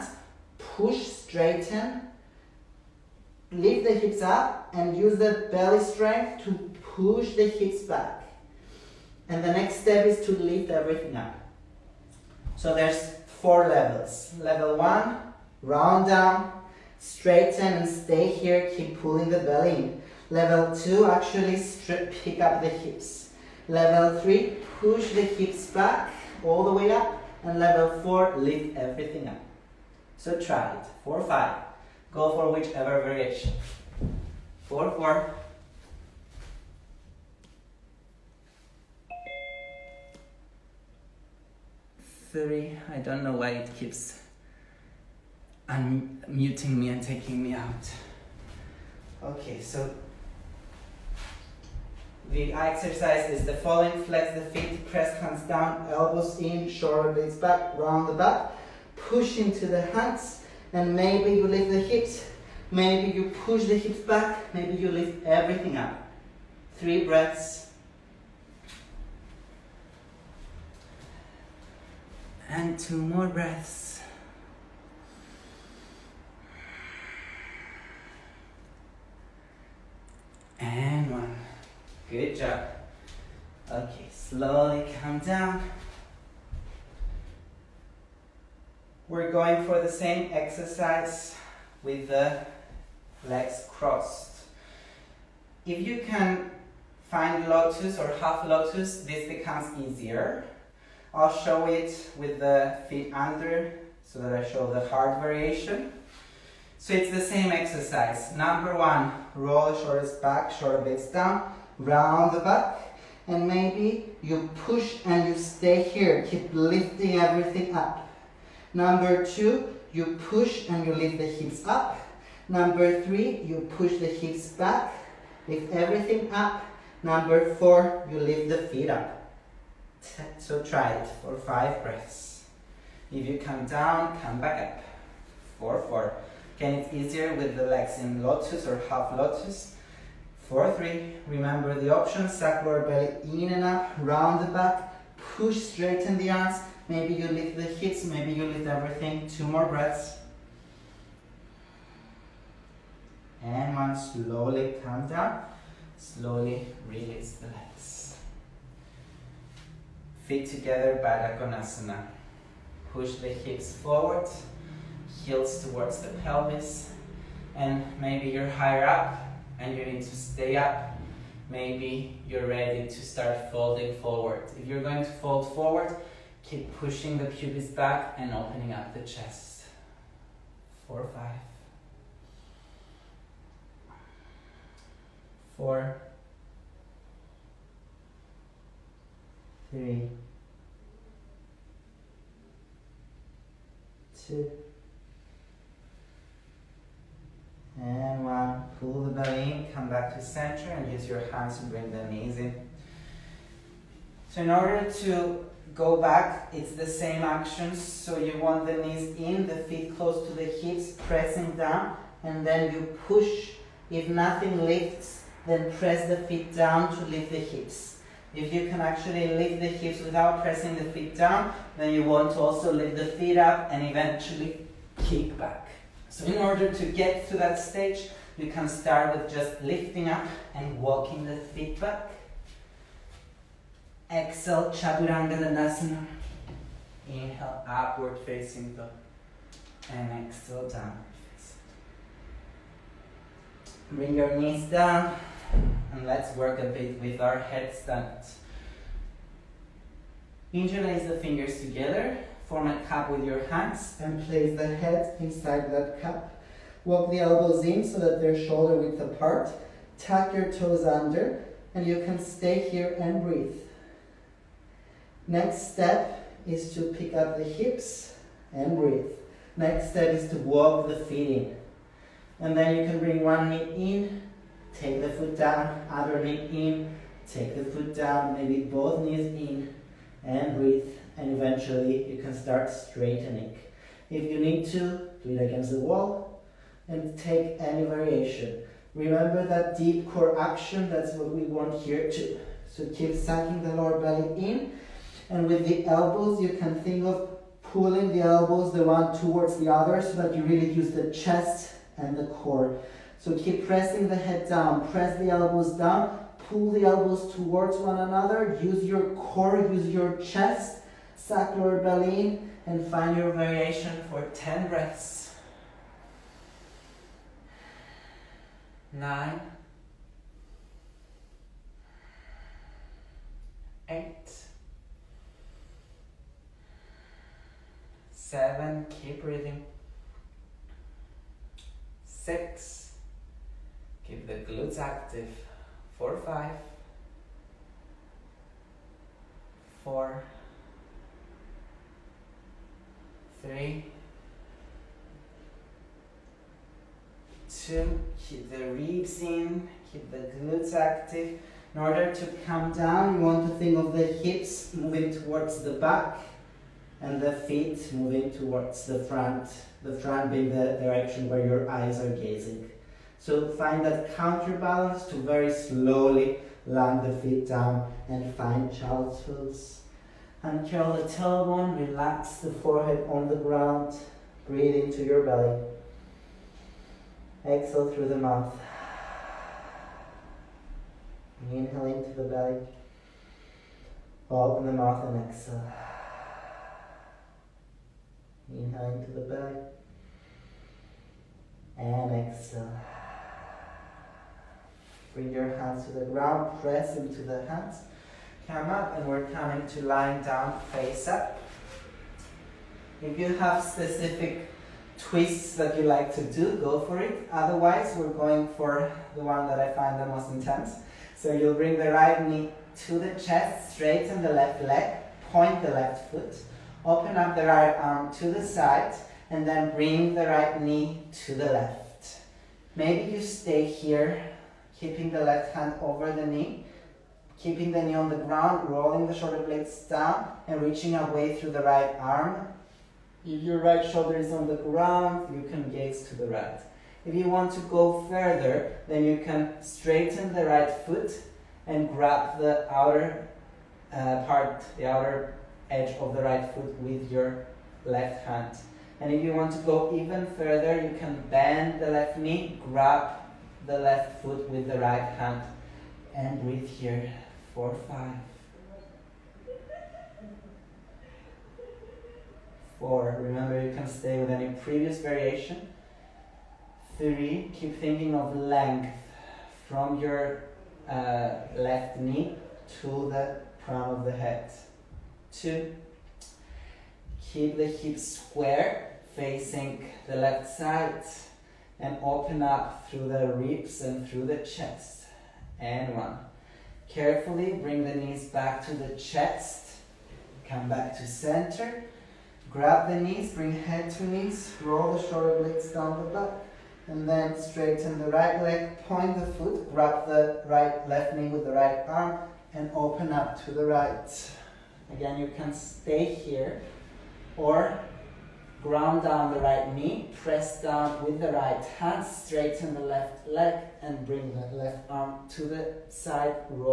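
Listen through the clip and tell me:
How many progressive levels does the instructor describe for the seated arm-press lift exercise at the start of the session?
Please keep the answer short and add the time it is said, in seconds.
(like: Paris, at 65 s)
4, at 13 s.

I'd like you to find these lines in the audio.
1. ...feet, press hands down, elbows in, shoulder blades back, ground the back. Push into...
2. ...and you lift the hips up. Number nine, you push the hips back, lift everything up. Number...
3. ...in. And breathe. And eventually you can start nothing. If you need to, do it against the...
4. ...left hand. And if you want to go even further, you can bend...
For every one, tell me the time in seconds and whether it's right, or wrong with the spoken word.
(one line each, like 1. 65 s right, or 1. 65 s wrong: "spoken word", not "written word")
1. 54 s wrong: "round", not "ground"
2. 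120 s wrong: "three", not "nine"
3. 279 s wrong: "straightening", not "nothing"
4. 447 s right.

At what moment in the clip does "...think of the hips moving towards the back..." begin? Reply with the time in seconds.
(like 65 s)
353 s.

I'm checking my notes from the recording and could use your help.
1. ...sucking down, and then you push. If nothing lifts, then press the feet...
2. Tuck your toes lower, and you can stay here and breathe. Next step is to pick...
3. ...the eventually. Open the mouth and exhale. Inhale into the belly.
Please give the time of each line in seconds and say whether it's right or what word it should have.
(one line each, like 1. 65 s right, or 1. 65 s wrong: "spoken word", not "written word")
1. 211 s wrong: "pressing", not "sucking"
2. 259 s wrong: "under", not "lower"
3. 382 s wrong: "belly", not "eventually".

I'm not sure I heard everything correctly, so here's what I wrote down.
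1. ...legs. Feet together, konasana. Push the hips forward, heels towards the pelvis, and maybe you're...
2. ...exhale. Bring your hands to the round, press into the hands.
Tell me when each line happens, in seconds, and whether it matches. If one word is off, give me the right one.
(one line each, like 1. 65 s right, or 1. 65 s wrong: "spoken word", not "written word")
1. 157 s right
2. 392 s wrong: "ground", not "round".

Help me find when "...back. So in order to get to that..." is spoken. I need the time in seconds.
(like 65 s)
225 s.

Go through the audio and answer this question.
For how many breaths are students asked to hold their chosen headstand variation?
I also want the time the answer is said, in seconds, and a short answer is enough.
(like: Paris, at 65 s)
10, at 314 s.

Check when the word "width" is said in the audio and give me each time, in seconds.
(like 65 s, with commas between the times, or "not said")
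258 s.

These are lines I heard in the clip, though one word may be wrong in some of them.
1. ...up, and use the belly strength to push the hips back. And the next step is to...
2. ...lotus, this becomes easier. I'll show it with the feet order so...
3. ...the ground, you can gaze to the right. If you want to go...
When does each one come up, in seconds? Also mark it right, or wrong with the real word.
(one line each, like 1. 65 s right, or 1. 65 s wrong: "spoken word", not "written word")
1. 4 s right
2. 98 s wrong: "under", not "order"
3. 434 s right.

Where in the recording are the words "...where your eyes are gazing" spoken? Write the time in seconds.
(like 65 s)
361 s.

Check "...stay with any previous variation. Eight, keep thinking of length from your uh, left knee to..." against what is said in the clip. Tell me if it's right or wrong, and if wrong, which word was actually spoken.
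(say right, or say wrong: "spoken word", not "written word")
wrong: "Three", not "Eight".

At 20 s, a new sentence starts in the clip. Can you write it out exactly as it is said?
Level two, actually strip, pick up the hips.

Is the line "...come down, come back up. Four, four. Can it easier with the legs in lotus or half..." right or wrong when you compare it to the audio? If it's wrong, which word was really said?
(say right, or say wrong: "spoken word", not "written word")
right.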